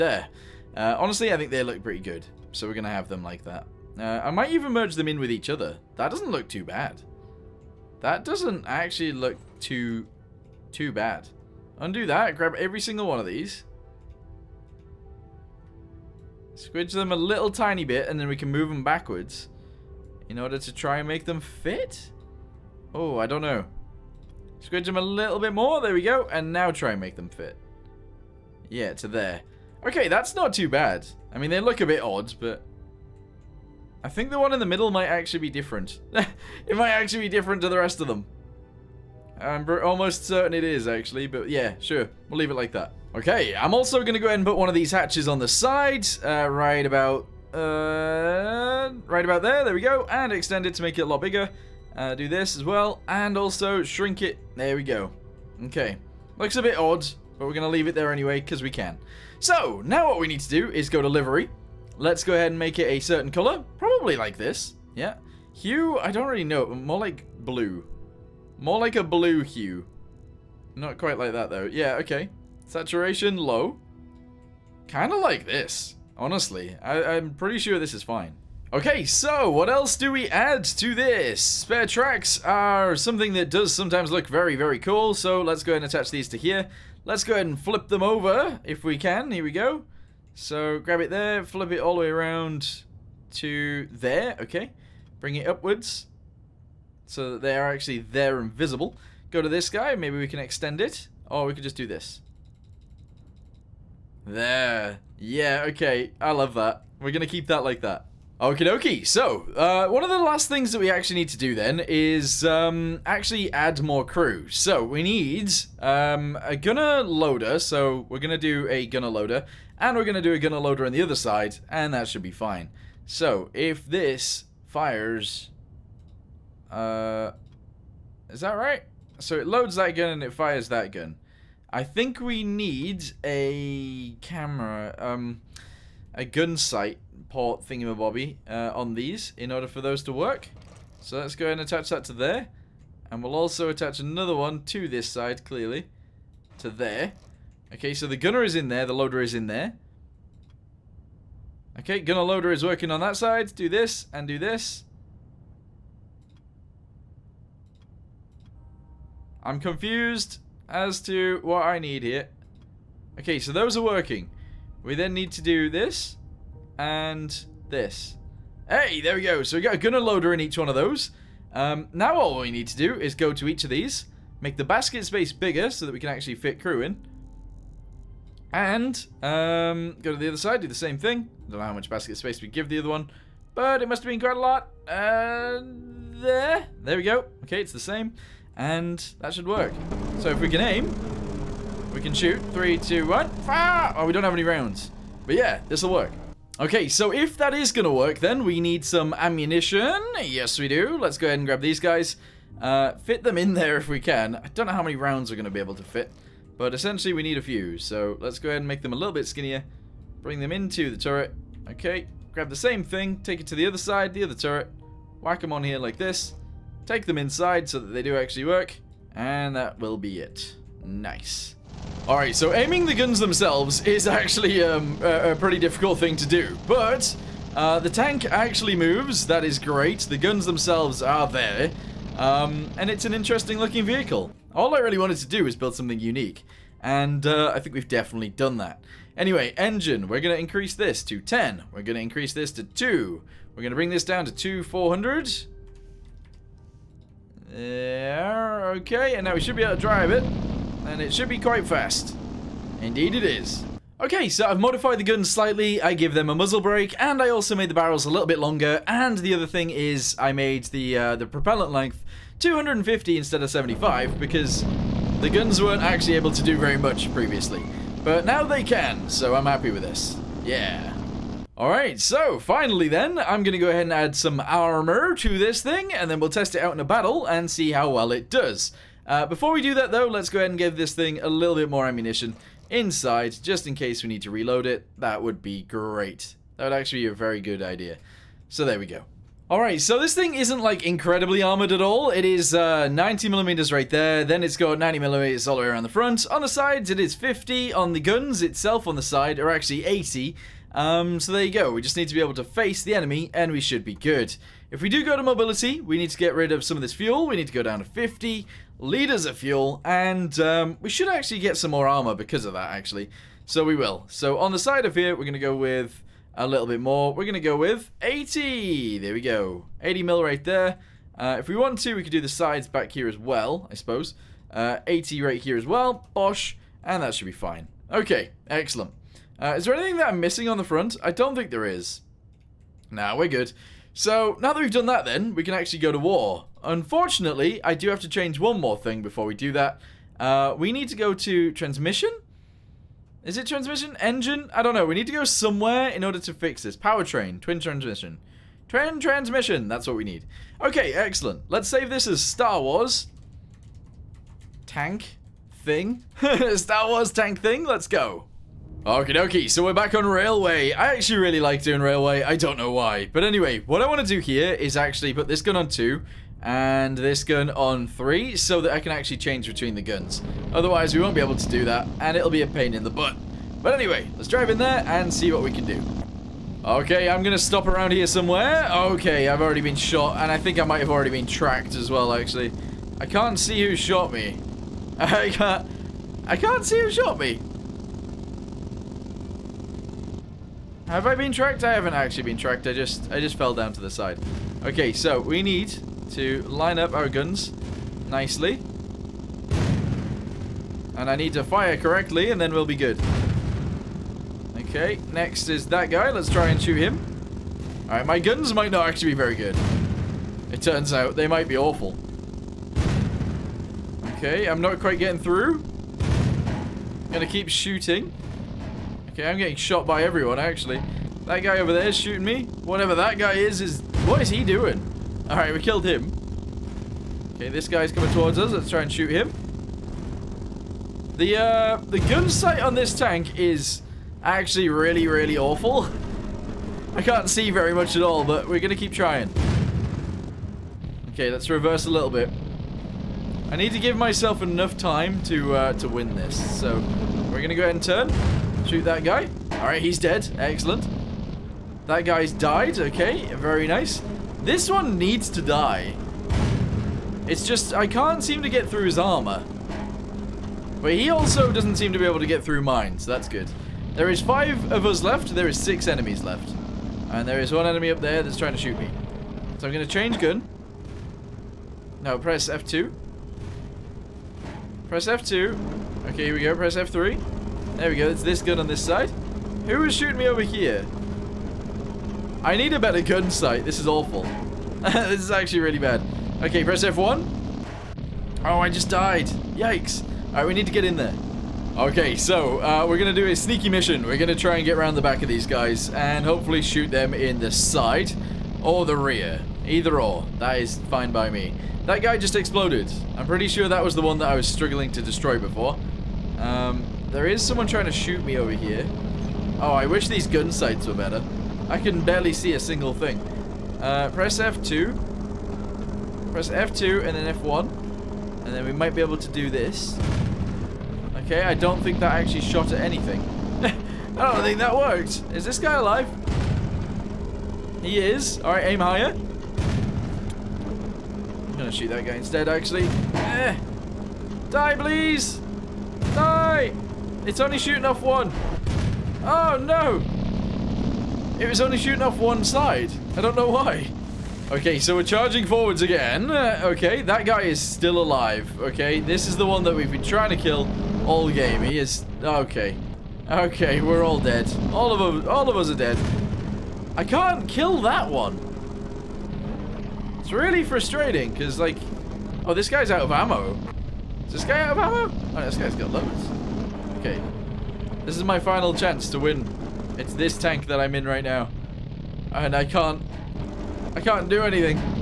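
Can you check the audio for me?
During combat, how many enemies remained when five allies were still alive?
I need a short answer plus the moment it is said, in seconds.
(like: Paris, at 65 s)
6, at 465 s.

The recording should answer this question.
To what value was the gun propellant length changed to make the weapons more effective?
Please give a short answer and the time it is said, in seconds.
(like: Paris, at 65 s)
250, at 262 s.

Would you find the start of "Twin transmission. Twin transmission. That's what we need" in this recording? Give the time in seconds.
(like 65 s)
347 s.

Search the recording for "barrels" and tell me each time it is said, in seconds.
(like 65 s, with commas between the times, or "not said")
257 s.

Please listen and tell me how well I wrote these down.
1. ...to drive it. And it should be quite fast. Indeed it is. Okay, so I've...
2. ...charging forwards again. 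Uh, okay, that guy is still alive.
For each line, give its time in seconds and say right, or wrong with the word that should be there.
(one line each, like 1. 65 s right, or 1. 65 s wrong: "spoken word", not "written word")
1. 249 s right
2. 545 s right.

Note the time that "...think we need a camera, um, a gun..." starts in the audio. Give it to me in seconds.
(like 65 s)
131 s.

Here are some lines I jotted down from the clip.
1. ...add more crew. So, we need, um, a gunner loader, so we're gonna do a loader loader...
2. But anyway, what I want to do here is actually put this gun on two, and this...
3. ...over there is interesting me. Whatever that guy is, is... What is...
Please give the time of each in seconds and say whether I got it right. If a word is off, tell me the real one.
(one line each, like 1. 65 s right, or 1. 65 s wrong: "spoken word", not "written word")
1. 113 s wrong: "gunner", not "loader"
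2. 363 s right
3. 421 s wrong: "shooting", not "interesting".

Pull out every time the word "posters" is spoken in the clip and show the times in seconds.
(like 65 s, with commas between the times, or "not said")
not said.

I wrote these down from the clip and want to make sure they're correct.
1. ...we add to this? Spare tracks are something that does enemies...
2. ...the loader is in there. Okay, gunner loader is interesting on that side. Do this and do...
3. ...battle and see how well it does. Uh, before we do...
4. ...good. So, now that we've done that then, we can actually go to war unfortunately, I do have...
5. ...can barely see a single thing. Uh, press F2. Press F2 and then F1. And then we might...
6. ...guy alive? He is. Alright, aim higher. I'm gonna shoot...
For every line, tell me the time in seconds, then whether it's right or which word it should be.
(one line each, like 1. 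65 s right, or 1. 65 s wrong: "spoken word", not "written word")
1. 80 s wrong: "sometimes", not "enemies"
2. 148 s wrong: "working", not "interesting"
3. 276 s right
4. 333 s right
5. 511 s right
6. 525 s right.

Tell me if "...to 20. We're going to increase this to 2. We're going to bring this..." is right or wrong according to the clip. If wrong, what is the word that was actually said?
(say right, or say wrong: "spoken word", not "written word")
wrong: "10", not "20".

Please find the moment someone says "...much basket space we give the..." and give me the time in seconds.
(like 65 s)
181 s.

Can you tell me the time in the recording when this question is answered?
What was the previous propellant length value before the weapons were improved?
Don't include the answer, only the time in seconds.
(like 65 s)
263 s.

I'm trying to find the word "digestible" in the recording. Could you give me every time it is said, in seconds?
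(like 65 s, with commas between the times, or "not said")
not said.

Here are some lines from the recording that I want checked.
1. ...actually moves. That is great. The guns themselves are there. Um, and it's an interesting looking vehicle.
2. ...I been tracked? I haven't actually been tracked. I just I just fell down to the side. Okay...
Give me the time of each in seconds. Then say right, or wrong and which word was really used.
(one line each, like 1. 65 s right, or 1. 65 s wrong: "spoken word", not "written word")
1. 228 s right
2. 391 s right.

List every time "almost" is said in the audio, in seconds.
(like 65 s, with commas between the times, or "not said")
39 s.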